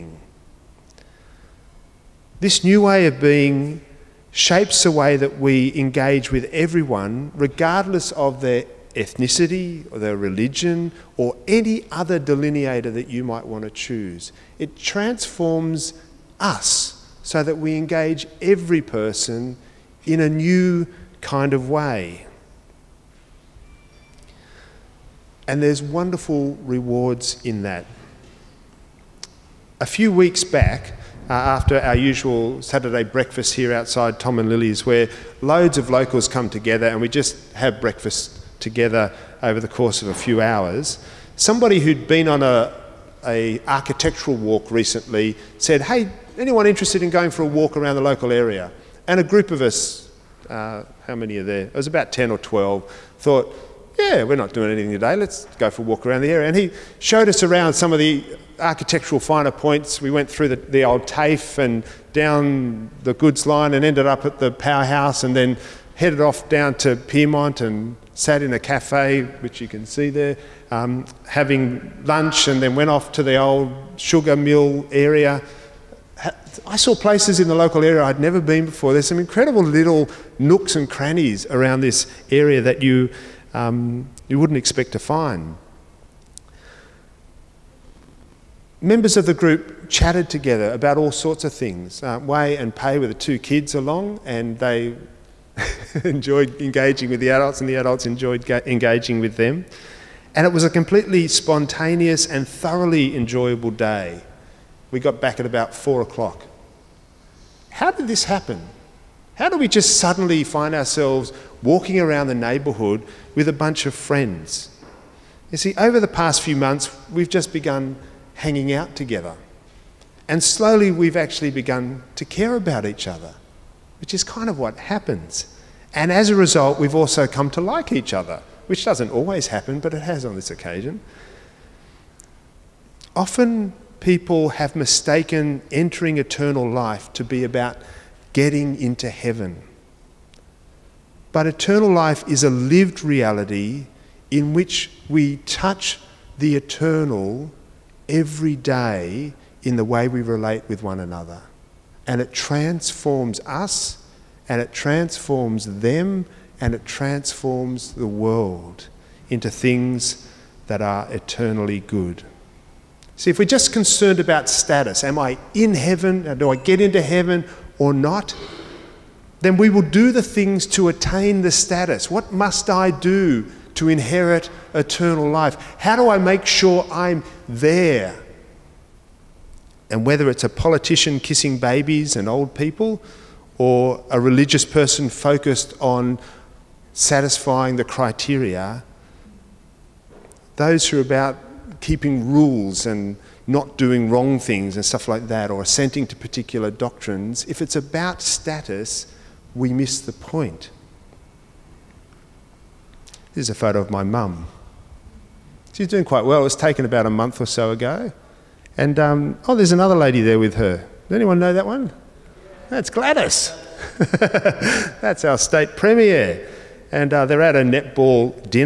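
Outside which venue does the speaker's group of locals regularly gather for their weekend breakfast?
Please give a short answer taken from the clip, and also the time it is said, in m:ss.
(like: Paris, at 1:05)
Tom and Lily's, at 0:34.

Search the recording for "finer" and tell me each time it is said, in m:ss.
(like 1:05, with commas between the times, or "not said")
0:59.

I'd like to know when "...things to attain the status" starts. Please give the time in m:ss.
2:50.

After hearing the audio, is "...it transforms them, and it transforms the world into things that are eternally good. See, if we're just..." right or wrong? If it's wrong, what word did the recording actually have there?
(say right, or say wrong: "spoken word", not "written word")
right.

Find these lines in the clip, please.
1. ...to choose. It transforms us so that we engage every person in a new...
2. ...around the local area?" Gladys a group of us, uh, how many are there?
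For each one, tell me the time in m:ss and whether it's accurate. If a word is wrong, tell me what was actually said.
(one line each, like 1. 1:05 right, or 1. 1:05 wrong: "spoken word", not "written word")
1. 0:13 right
2. 0:47 wrong: "And", not "Gladys".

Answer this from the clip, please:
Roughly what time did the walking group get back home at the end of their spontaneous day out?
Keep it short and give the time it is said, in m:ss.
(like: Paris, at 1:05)
4 o'clock, at 1:45.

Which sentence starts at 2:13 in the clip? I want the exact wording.
Often, people have mistaken entering eternal life to be about getting into heaven.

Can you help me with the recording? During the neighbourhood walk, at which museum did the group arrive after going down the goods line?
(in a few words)
the Powerhouse.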